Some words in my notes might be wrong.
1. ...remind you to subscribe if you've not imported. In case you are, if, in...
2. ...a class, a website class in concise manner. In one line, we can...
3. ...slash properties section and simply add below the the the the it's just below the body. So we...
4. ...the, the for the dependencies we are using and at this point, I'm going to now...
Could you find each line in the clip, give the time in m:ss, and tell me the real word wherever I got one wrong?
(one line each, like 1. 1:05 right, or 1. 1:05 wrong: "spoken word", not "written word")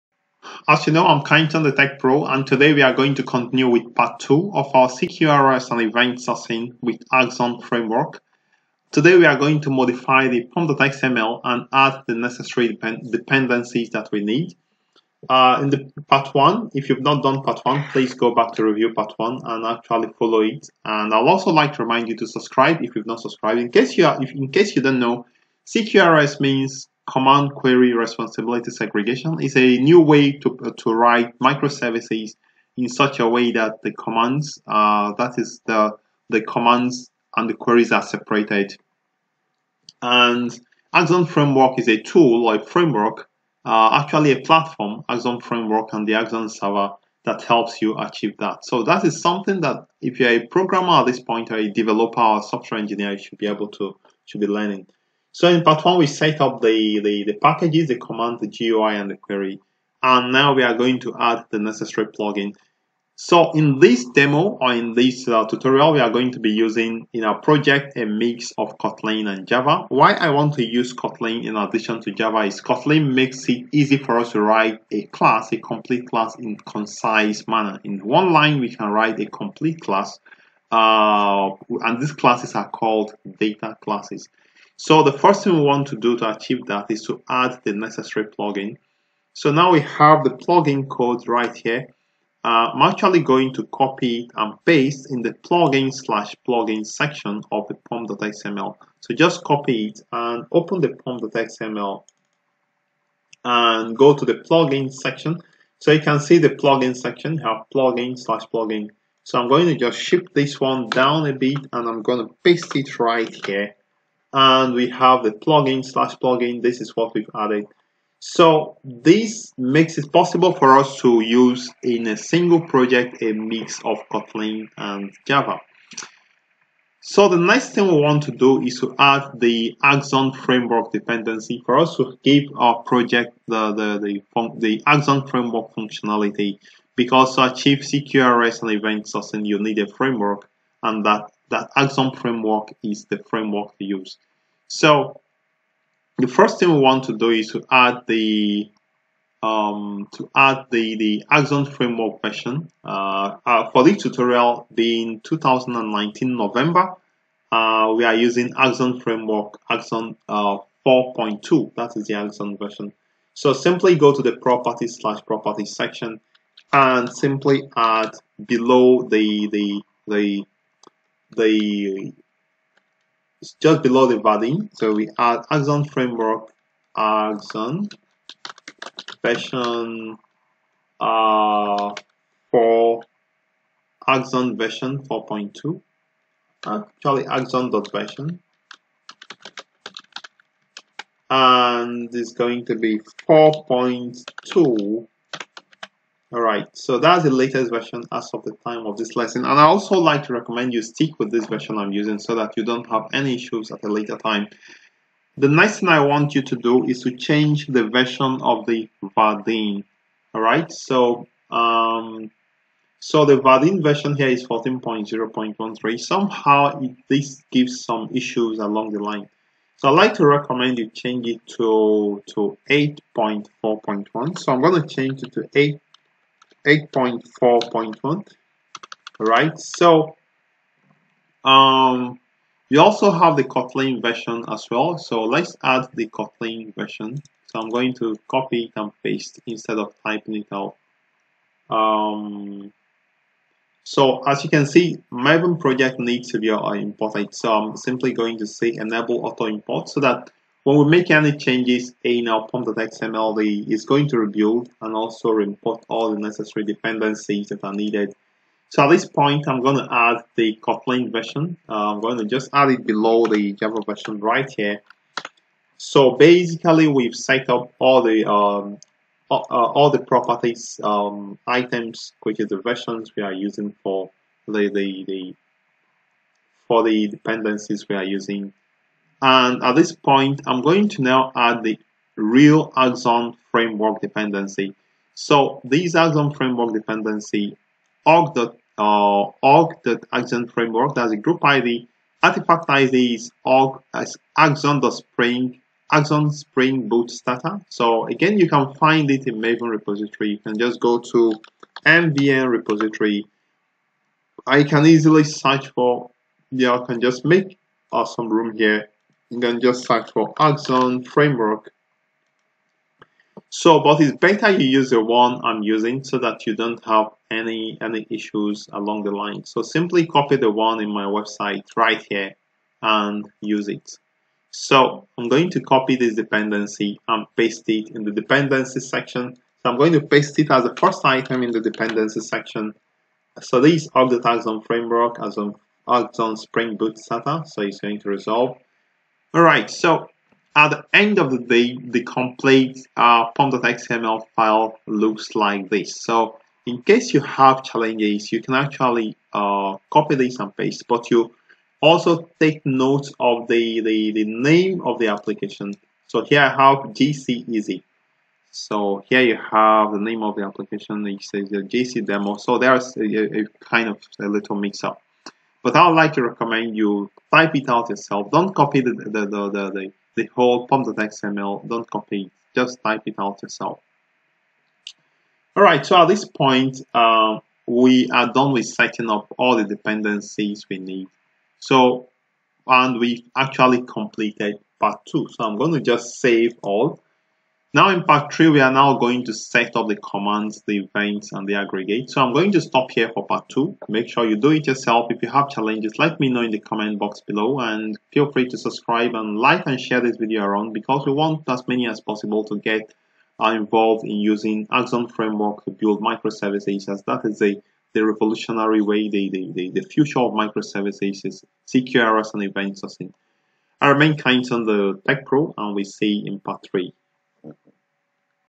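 1. 0:21 wrong: "subscribed", not "imported"
2. 1:14 wrong: "complete", not "website"
3. 2:45 right
4. 4:34 right.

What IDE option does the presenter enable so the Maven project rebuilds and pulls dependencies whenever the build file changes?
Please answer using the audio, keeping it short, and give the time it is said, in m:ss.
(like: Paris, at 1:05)
enable auto import, at 4:08.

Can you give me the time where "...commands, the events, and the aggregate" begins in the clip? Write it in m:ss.
6:29.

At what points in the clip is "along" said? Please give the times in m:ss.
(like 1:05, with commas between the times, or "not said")
3:38, 5:18.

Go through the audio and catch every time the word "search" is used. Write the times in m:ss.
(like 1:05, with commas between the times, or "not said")
5:05, 5:09.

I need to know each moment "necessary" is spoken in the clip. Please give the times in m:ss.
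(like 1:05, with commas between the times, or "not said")
0:12, 1:01, 1:27, 4:16.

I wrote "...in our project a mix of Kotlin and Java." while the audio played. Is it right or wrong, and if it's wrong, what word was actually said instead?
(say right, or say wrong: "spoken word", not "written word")
right.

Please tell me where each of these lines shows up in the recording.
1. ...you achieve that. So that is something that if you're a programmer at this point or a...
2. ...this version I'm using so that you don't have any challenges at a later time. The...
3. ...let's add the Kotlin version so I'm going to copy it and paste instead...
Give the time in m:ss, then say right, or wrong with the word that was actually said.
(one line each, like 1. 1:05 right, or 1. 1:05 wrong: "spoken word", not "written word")
1. 0:47 right
2. 3:21 wrong: "issues", not "challenges"
3. 3:55 right.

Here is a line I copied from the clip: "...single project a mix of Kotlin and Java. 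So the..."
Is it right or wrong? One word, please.
right.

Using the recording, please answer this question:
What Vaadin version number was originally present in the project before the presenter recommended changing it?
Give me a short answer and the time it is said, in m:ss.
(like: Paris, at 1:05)
14.0.13, at 3:34.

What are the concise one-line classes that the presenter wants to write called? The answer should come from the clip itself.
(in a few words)
data classes.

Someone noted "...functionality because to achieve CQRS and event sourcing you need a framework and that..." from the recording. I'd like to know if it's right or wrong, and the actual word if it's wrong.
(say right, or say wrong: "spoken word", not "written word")
right.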